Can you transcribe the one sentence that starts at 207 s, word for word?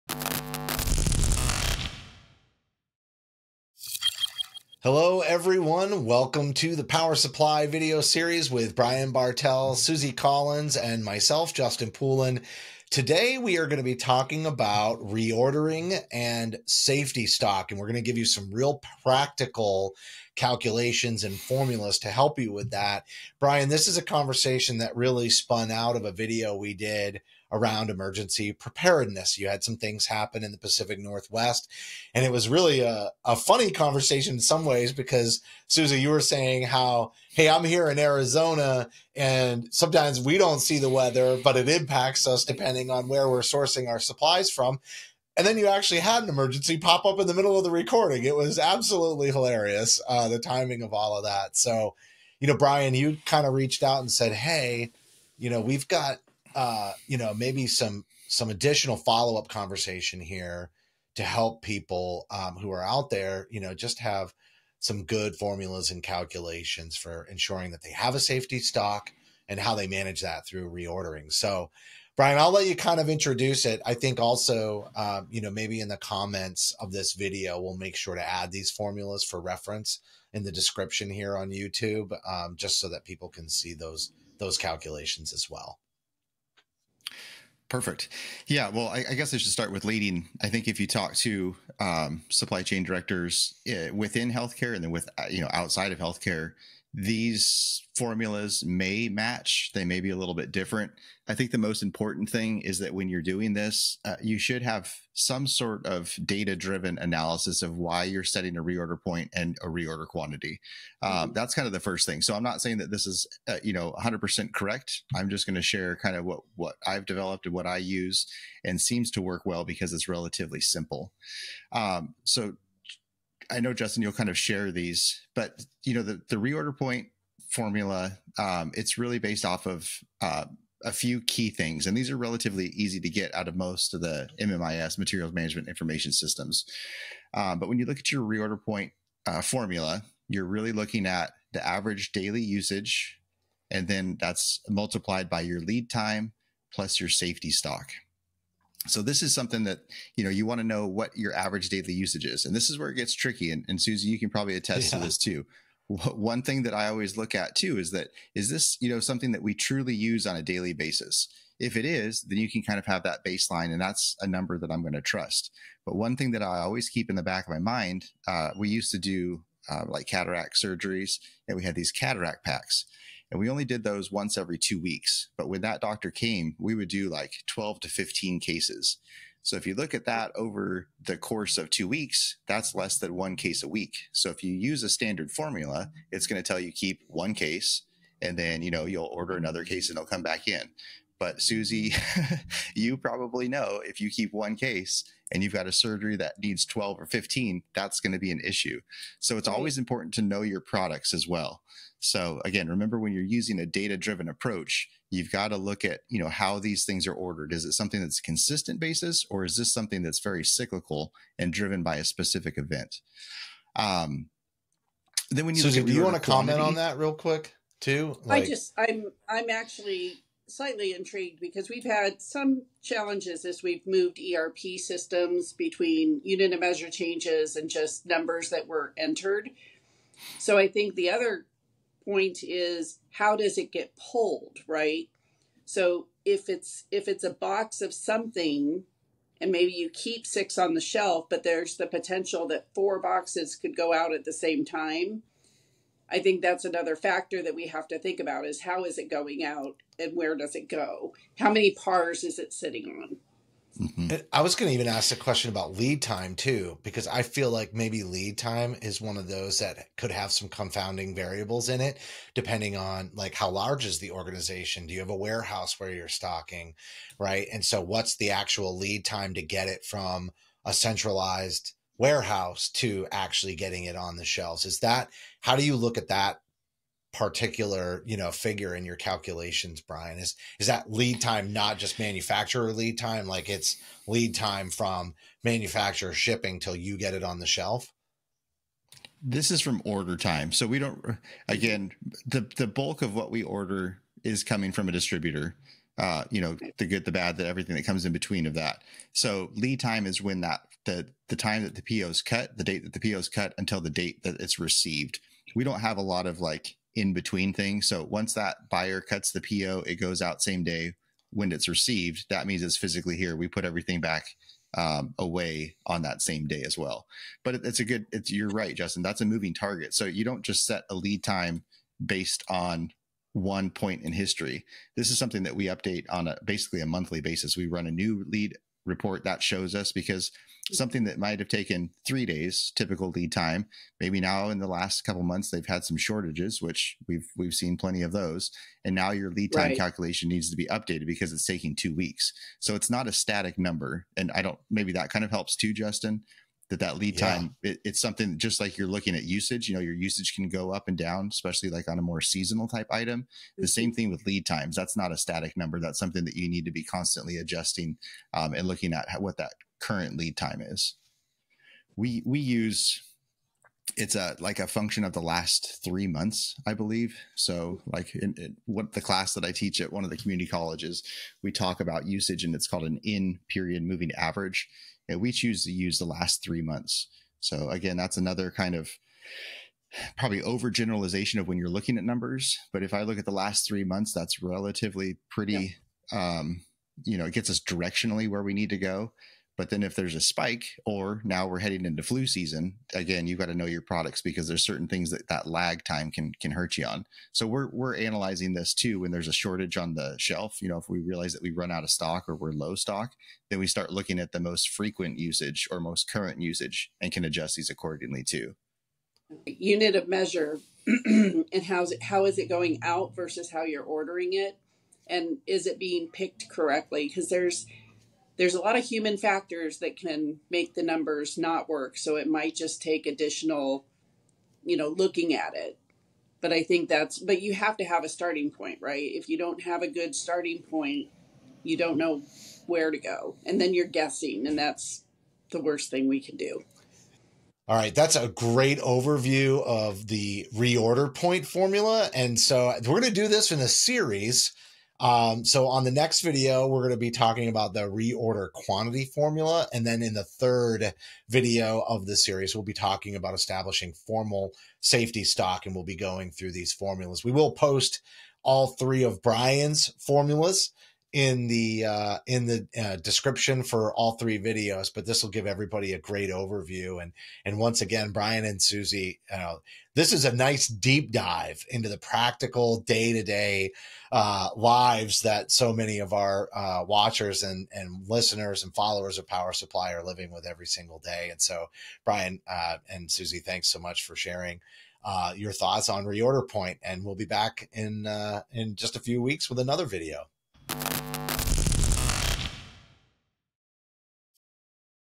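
Is it something that's consistent basis or is this something that's very cyclical and driven by a specific event?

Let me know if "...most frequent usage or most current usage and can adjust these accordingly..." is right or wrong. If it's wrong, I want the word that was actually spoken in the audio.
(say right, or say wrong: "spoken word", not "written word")
right.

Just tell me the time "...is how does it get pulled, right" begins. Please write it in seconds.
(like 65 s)
232 s.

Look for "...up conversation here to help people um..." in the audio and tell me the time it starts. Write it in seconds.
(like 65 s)
59 s.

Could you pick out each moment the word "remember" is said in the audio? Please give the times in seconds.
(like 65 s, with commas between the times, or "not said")
202 s.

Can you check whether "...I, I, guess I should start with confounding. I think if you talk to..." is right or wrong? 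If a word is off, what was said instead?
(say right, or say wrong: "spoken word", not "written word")
wrong: "leading", not "confounding".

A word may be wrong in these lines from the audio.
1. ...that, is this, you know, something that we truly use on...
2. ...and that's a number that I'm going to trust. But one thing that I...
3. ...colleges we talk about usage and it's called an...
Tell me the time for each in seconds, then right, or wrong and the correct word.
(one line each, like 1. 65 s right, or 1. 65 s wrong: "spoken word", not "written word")
1. 157 s right
2. 163 s right
3. 370 s right.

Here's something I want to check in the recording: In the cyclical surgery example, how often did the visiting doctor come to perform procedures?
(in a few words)
Once every two weeks.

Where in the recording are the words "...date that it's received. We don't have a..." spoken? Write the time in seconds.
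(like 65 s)
303 s.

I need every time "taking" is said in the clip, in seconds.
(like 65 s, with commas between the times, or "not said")
341 s.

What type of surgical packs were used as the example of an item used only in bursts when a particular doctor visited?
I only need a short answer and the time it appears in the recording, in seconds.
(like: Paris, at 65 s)
Cataract packs, at 171 s.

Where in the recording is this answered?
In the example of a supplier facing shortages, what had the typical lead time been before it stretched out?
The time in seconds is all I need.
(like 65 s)
332 s.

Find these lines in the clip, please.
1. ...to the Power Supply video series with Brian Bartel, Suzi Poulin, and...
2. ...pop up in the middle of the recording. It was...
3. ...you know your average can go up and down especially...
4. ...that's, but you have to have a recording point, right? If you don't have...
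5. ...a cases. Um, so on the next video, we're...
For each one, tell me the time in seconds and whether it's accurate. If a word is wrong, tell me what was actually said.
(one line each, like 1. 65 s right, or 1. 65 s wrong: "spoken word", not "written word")
1. 6 s wrong: "Collins", not "Poulin"
2. 46 s right
3. 349 s wrong: "usage", not "average"
4. 426 s wrong: "starting", not "recording"
5. 443 s wrong: "series", not "cases".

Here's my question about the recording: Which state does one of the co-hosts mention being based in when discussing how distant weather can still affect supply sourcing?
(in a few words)
Arizona.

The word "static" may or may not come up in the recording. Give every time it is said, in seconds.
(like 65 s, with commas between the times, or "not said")
343 s, 355 s.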